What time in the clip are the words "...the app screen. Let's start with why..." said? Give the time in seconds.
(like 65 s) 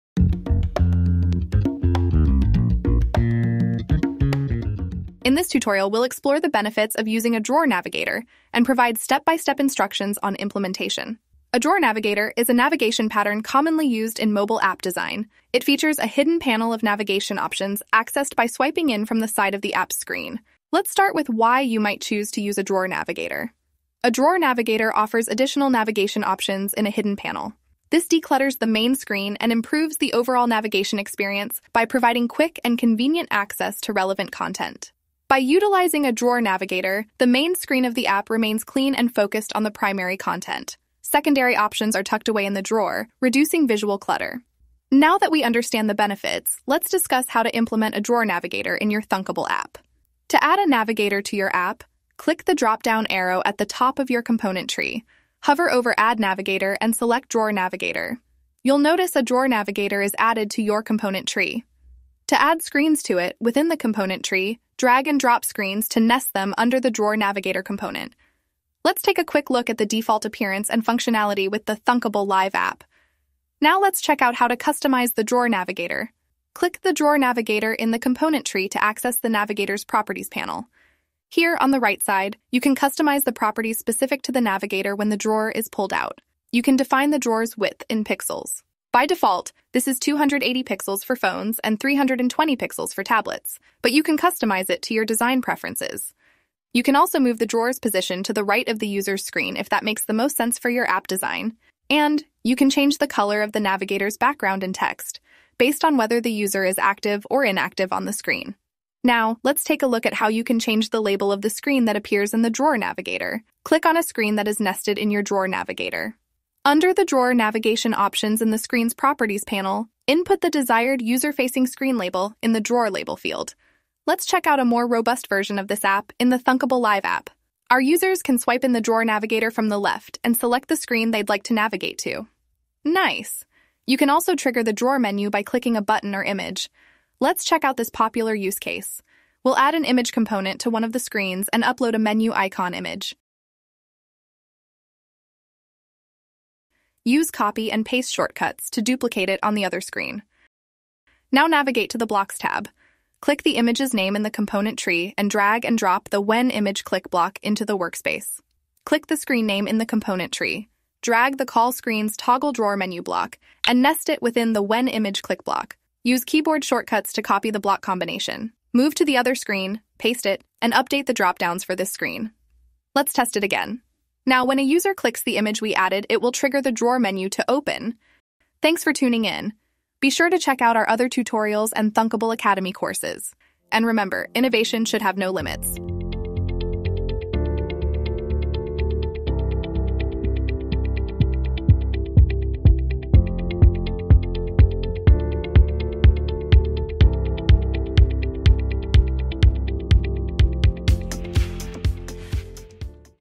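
19 s.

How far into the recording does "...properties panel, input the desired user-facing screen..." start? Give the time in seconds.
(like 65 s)
118 s.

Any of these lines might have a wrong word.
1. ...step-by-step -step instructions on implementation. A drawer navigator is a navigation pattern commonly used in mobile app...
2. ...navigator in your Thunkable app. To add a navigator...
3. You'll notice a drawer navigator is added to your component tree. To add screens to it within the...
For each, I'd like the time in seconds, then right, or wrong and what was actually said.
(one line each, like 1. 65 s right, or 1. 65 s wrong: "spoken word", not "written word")
1. 8 s right
2. 48 s right
3. 58 s right.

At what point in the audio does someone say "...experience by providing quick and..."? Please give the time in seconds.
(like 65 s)
30 s.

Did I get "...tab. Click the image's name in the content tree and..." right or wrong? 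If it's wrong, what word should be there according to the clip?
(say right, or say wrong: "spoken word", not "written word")
wrong: "component", not "content".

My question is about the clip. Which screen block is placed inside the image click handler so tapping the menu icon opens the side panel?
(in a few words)
Toggle Drawer.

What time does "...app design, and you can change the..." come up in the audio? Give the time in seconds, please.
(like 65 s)
100 s.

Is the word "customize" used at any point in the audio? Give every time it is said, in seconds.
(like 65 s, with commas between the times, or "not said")
74 s, 82 s, 94 s.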